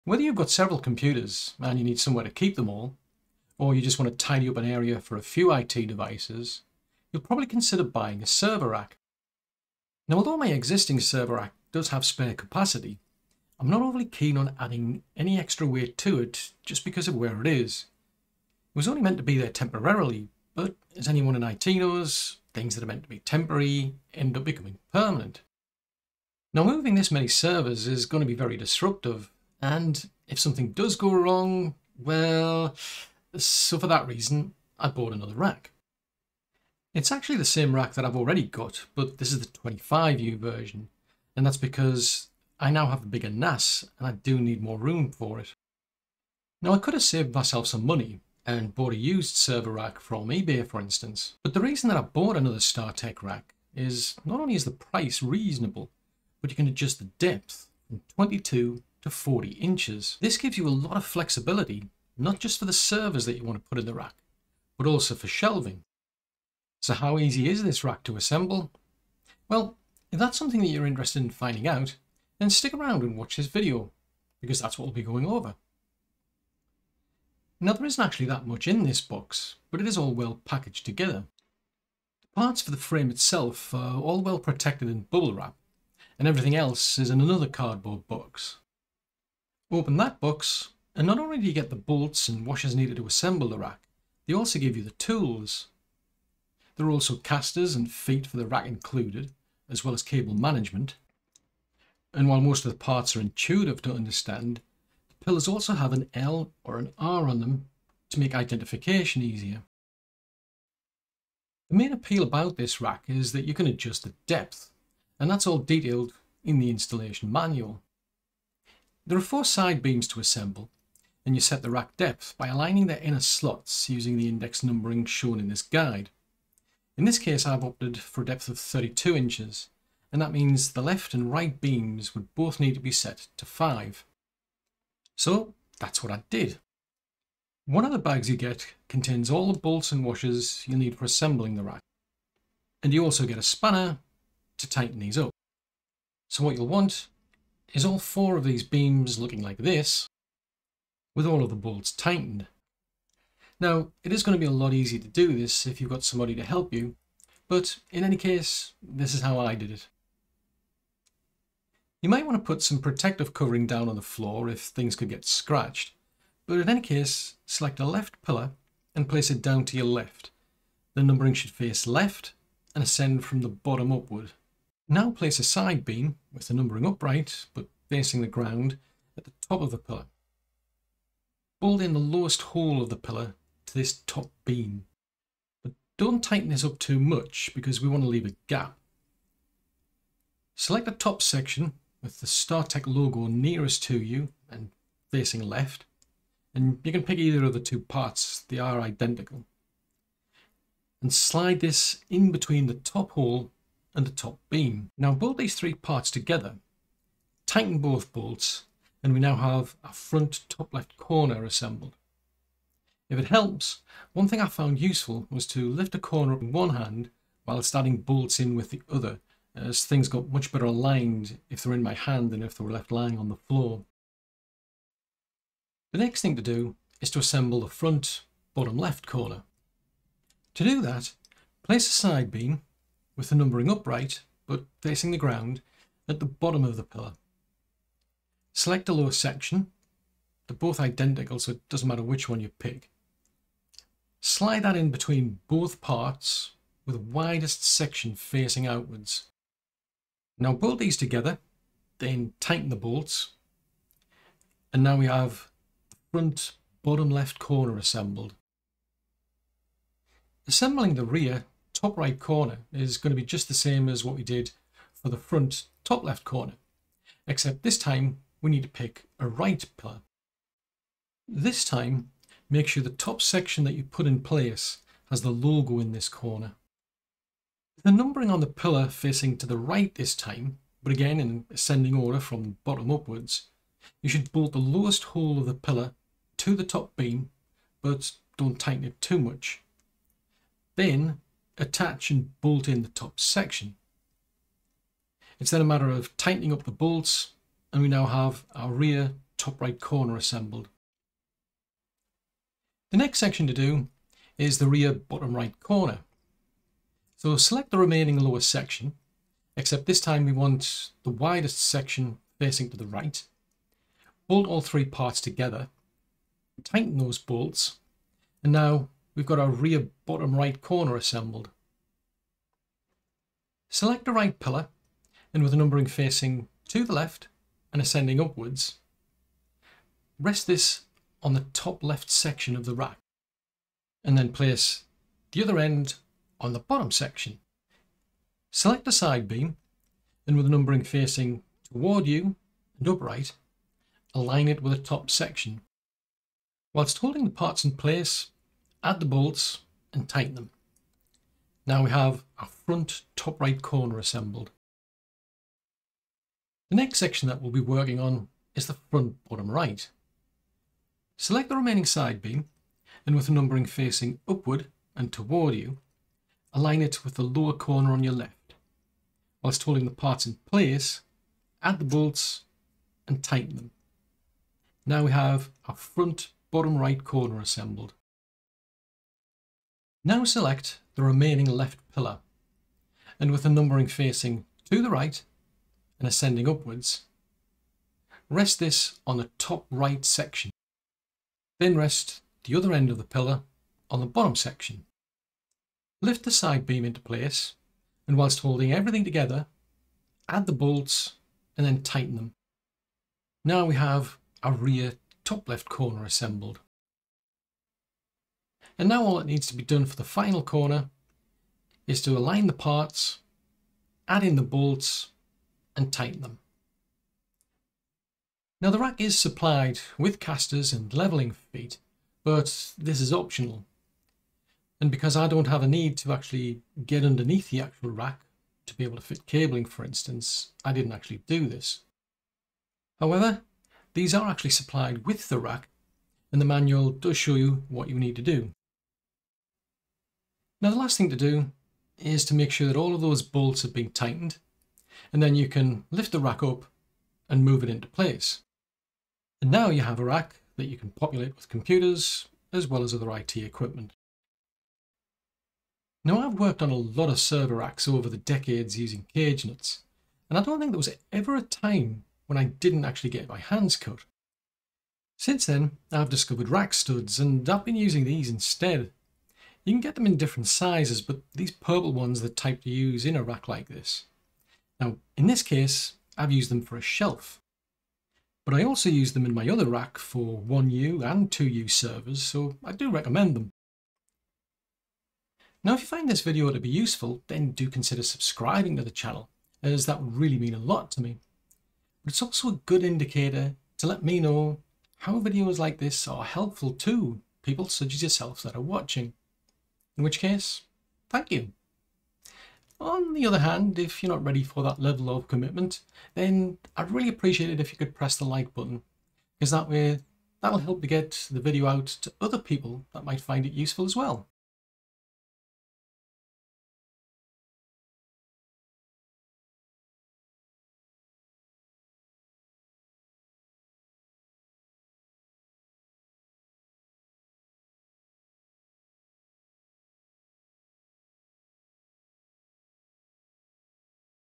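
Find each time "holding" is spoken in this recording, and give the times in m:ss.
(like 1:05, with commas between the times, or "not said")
5:46, 6:09, 6:38.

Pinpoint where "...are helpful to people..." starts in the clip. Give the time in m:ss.
8:16.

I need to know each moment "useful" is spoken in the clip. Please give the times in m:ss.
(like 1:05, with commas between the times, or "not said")
3:34, 8:06, 8:33.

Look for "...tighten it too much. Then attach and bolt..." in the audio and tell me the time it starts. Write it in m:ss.
4:48.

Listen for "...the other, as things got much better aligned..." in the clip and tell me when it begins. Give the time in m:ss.
3:38.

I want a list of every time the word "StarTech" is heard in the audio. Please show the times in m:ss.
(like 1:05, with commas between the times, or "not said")
0:52, 3:12.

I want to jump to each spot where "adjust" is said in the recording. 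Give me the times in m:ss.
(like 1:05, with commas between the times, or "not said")
0:56, 1:53.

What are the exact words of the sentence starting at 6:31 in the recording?
Then rest the other end of the pillar on the bottom section.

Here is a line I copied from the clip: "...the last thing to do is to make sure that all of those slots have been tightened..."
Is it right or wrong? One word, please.
wrong.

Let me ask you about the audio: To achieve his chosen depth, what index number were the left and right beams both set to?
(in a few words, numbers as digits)
5.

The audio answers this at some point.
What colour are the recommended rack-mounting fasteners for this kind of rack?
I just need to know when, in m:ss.
7:51.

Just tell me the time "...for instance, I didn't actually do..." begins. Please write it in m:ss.
7:09.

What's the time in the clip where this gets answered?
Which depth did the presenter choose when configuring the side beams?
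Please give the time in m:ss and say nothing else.
2:08.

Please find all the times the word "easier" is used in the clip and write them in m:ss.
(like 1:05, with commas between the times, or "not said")
1:49, 2:34.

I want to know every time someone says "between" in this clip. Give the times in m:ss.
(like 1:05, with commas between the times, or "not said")
3:22, 4:04.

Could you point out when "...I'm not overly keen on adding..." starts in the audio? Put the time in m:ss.
0:13.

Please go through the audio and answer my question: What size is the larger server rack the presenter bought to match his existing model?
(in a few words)
25U.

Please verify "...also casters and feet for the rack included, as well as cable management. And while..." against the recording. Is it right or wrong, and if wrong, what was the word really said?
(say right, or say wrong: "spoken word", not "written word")
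right.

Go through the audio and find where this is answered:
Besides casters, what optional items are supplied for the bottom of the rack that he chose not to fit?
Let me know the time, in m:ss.
7:00.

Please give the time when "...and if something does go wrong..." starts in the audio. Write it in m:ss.
0:29.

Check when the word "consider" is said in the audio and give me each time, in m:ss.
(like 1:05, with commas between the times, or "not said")
0:07, 8:07.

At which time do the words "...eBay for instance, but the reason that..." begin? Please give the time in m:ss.
0:50.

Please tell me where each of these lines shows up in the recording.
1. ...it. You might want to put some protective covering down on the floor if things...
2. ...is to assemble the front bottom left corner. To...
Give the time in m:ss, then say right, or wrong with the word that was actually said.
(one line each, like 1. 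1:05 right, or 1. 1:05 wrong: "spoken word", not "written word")
1. 2:39 right
2. 3:47 right.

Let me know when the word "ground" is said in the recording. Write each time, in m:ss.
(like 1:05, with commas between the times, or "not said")
2:58, 3:55.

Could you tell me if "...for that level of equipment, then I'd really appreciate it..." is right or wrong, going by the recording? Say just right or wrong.
wrong.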